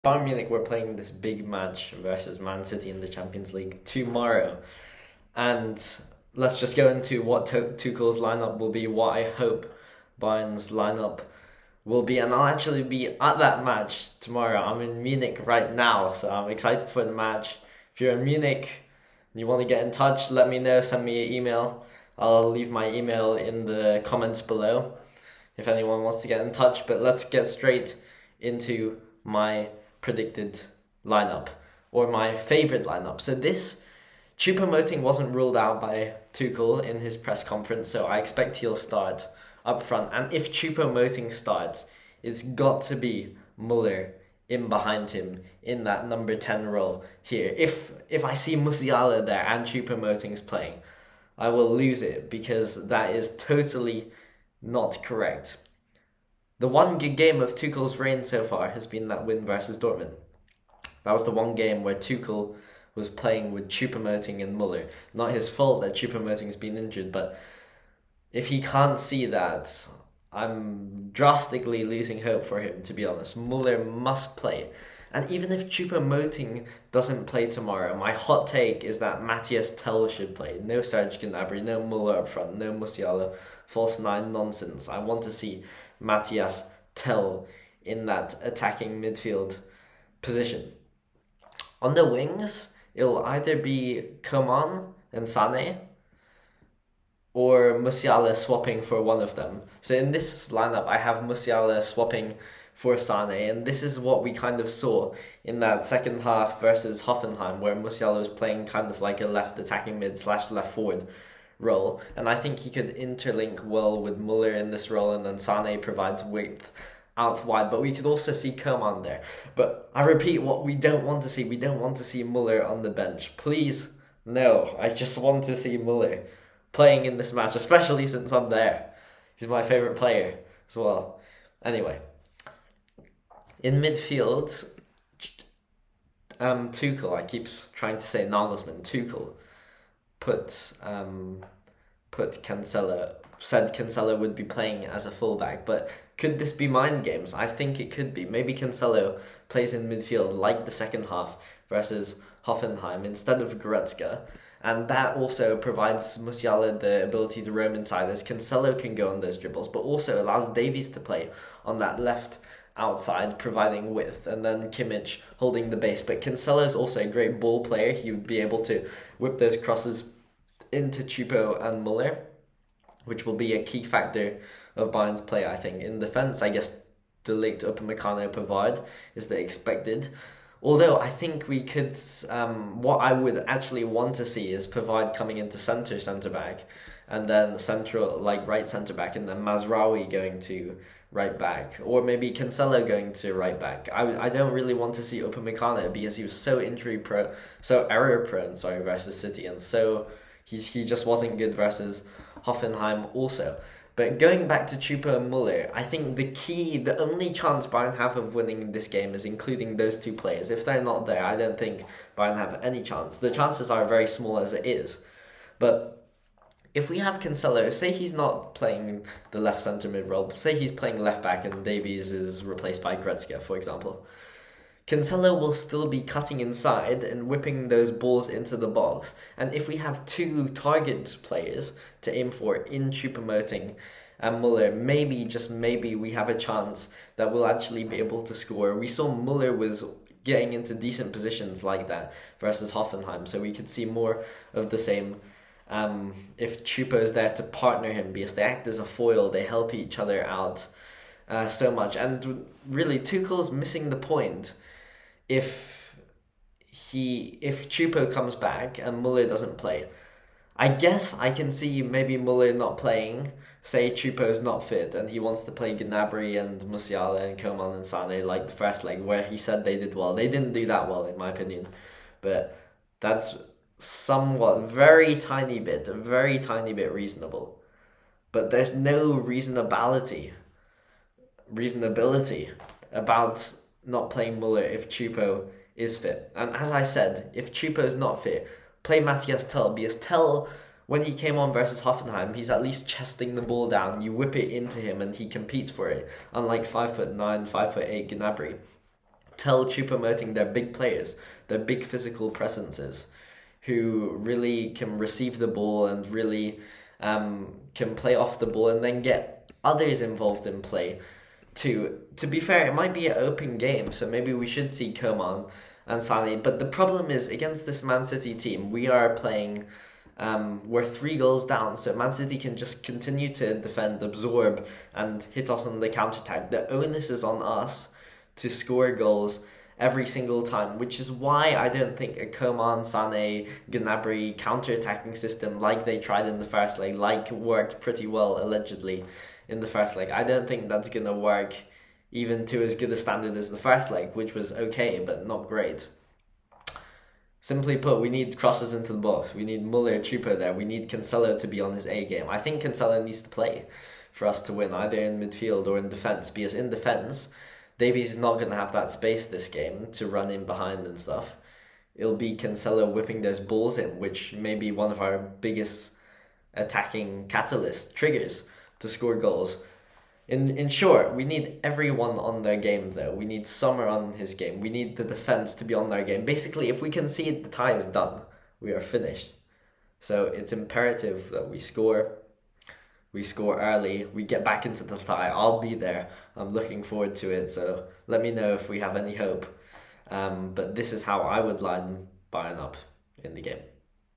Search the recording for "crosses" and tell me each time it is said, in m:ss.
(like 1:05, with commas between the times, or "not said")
2:49, 5:48.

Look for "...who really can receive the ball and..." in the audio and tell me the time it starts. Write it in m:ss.
5:03.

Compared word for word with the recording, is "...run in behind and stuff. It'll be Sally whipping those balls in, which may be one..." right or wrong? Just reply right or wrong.
wrong.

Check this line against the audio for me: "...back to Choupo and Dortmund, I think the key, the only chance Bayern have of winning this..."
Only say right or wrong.
wrong.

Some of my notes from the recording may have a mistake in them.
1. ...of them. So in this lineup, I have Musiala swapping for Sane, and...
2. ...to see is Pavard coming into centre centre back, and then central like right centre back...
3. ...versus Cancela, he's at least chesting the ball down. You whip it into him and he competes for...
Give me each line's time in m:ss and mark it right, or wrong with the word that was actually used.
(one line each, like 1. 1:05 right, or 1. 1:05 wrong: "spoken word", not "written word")
1. 1:39 right
2. 3:04 right
3. 4:51 wrong: "Hoffenheim", not "Cancela".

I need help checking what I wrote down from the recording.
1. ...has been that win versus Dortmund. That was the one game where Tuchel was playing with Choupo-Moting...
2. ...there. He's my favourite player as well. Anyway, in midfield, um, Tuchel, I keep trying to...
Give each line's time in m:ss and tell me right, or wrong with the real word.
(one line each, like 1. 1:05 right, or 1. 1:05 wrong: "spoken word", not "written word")
1. 0:58 right
2. 2:08 right.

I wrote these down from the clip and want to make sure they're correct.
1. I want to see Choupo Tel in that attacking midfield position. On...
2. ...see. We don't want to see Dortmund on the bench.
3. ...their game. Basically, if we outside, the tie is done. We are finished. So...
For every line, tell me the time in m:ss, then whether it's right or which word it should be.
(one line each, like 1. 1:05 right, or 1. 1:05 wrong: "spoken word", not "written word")
1. 1:24 wrong: "Mathys", not "Choupo"
2. 2:01 wrong: "Muller", not "Dortmund"
3. 6:15 wrong: "concede", not "outside".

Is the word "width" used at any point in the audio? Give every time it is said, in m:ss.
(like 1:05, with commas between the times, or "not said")
1:56, 2:43.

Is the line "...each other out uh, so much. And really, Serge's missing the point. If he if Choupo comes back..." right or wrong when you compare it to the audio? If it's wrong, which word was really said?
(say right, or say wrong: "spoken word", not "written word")
wrong: "Tuchel", not "Serge".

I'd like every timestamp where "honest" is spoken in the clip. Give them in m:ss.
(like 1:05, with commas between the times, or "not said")
1:13.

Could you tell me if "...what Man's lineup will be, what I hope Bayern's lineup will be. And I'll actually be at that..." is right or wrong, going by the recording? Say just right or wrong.
wrong.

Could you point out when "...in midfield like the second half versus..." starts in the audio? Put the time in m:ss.
2:29.